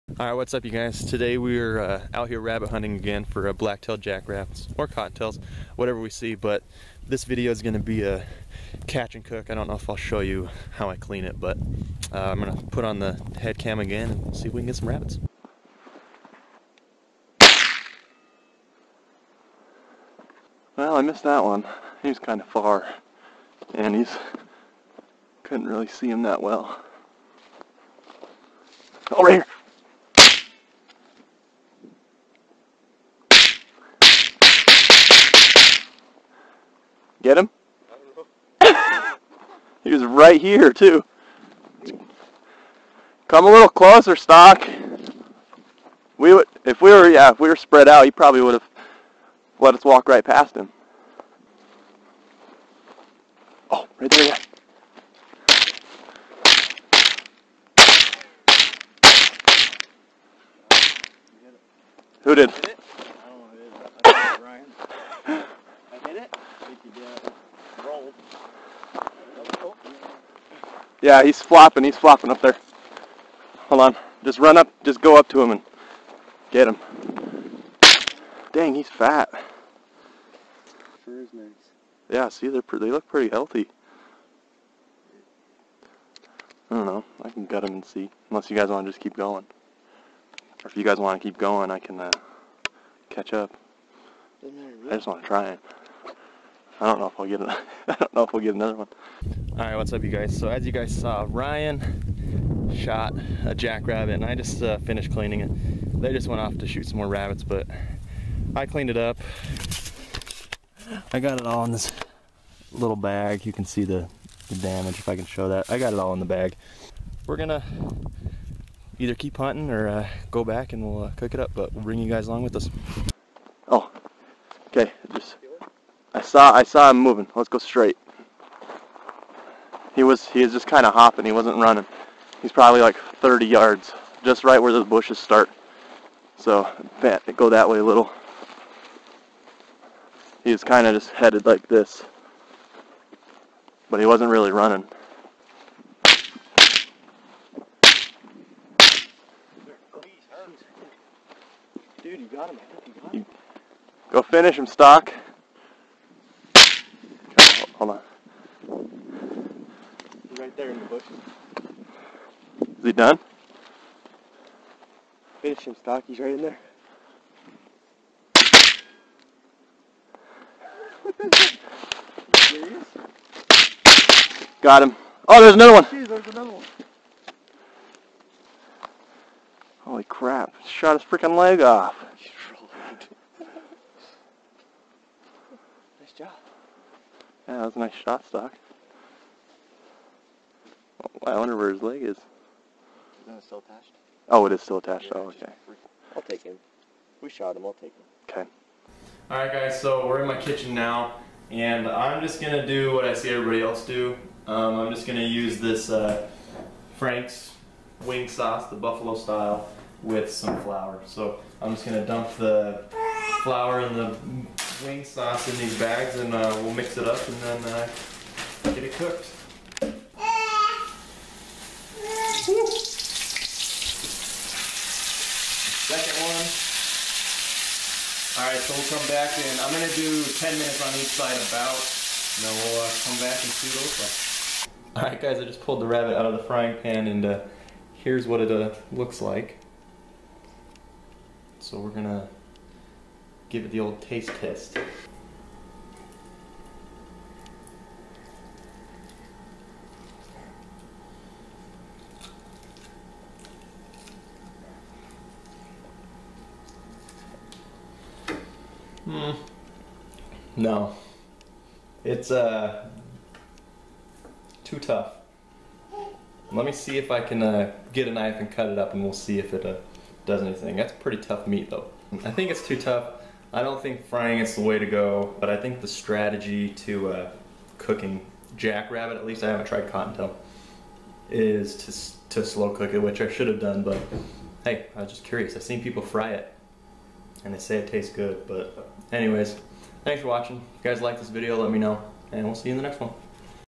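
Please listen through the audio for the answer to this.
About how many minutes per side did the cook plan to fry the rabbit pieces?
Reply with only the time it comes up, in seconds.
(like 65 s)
230 s.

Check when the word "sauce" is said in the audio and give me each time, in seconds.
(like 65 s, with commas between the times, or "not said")
208 s, 215 s.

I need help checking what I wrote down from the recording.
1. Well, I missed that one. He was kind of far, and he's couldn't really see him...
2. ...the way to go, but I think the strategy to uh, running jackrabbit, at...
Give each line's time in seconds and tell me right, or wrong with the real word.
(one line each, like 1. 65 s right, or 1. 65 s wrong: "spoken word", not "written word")
1. 20 s right
2. 274 s wrong: "cooking", not "running".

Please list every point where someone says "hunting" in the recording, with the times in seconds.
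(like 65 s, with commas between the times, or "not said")
2 s, 119 s.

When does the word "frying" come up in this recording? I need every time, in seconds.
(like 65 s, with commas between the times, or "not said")
236 s, 274 s.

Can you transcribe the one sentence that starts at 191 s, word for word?
I wonder where his leg is.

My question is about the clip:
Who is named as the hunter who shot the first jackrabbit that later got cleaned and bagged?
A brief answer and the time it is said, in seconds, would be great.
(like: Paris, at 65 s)
Ryan, at 101 s.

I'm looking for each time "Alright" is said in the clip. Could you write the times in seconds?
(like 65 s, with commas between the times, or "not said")
0 s, 228 s, 235 s.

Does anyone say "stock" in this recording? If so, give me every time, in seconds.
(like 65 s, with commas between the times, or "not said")
44 s, 154 s, 165 s, 188 s.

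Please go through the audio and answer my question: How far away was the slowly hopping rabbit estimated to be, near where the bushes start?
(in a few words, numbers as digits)
30 yards.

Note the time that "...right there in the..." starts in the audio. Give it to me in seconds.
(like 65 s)
160 s.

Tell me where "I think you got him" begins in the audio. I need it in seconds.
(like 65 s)
152 s.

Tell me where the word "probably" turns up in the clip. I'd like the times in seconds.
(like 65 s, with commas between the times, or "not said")
48 s, 132 s.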